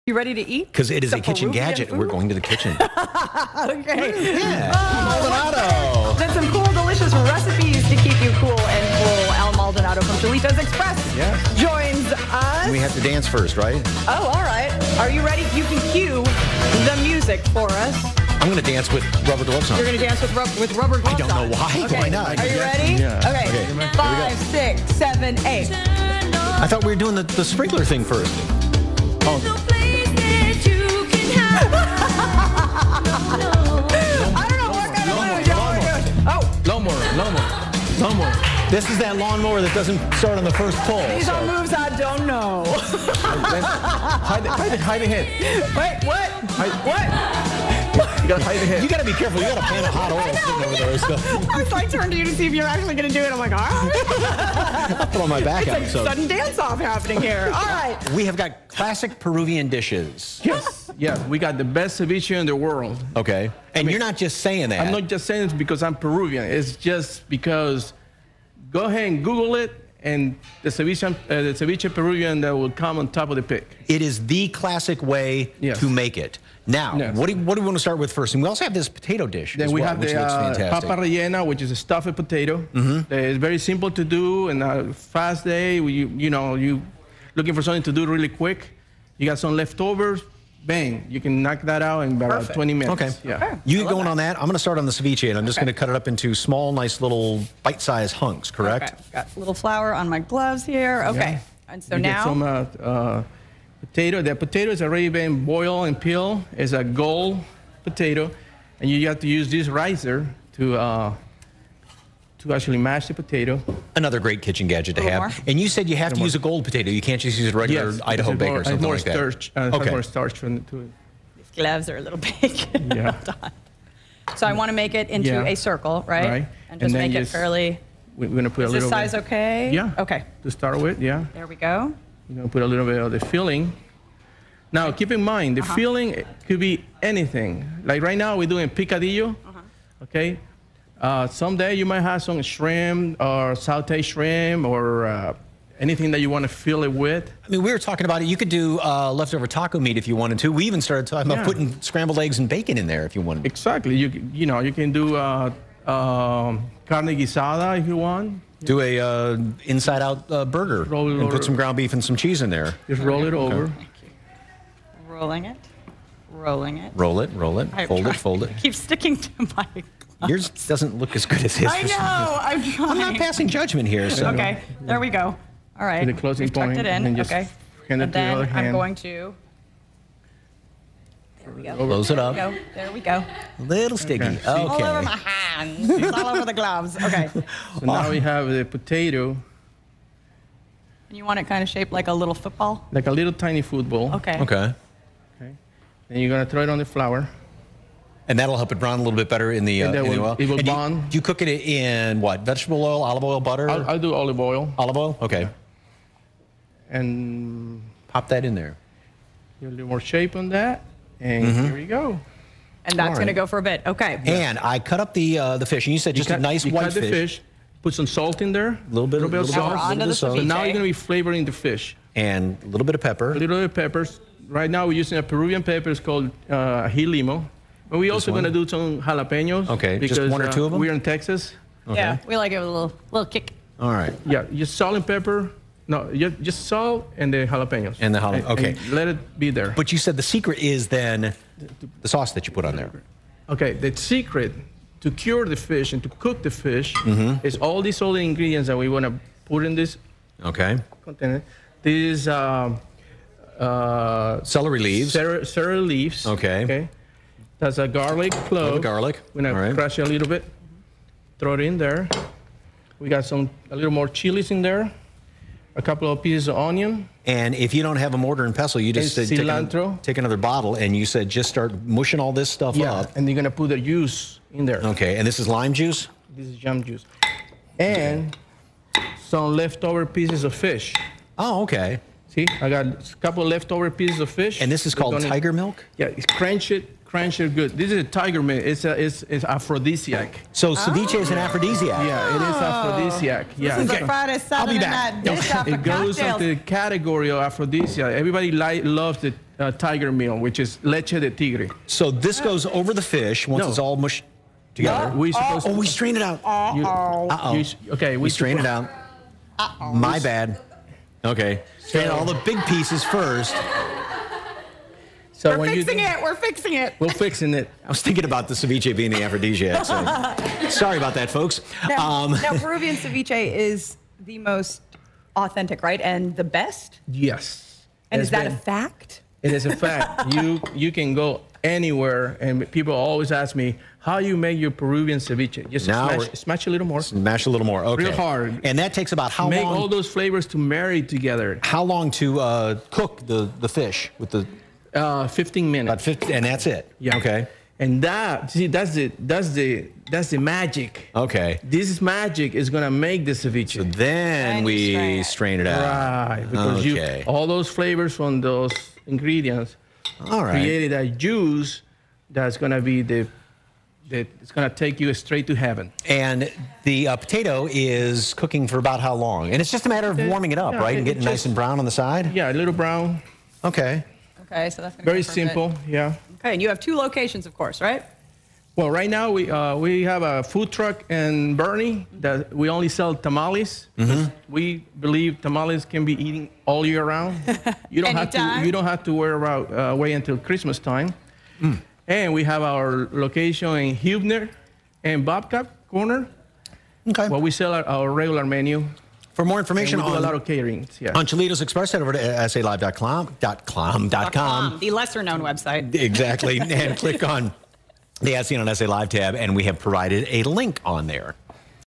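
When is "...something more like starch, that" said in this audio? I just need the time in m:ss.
1:58.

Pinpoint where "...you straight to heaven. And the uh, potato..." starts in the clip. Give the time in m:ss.
6:04.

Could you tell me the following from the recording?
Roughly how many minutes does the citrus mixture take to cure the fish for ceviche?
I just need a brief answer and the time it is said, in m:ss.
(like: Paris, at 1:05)
15 minutes, at 5:45.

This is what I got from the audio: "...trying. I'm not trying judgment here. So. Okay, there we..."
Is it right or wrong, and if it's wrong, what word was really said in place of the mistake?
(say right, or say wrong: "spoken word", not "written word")
wrong: "passing", not "trying".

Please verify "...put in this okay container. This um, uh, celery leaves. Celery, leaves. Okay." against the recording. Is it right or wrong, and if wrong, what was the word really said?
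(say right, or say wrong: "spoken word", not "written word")
right.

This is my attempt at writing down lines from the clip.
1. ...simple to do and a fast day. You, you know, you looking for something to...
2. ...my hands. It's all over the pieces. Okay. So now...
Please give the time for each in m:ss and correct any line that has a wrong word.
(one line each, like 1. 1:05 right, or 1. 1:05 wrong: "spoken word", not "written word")
1. 1:23 right
2. 3:05 wrong: "gloves", not "pieces".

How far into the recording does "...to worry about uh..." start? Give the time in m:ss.
6:29.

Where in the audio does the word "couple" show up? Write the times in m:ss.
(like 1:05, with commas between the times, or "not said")
4:25, 4:43.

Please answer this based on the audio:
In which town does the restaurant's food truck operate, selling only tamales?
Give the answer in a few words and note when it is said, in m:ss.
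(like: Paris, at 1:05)
Boerne, at 6:21.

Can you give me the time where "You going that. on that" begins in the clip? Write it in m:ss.
1:33.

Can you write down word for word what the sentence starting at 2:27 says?
I mean, we were talking about it.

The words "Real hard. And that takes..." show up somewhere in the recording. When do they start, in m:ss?
5:38.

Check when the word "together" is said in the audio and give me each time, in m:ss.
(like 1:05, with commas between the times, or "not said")
5:04, 5:41.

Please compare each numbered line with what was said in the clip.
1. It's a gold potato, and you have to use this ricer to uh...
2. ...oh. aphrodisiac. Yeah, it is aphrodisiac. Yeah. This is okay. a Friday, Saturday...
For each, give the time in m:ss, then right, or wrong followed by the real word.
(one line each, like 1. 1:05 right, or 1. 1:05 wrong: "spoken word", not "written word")
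1. 1:46 right
2. 4:51 right.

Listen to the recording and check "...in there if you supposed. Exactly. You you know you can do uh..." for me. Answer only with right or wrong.
wrong.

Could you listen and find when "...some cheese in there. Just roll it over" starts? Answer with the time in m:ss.
2:42.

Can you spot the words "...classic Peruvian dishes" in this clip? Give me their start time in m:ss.
0:58.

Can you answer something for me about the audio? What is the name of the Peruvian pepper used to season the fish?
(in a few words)
Limo.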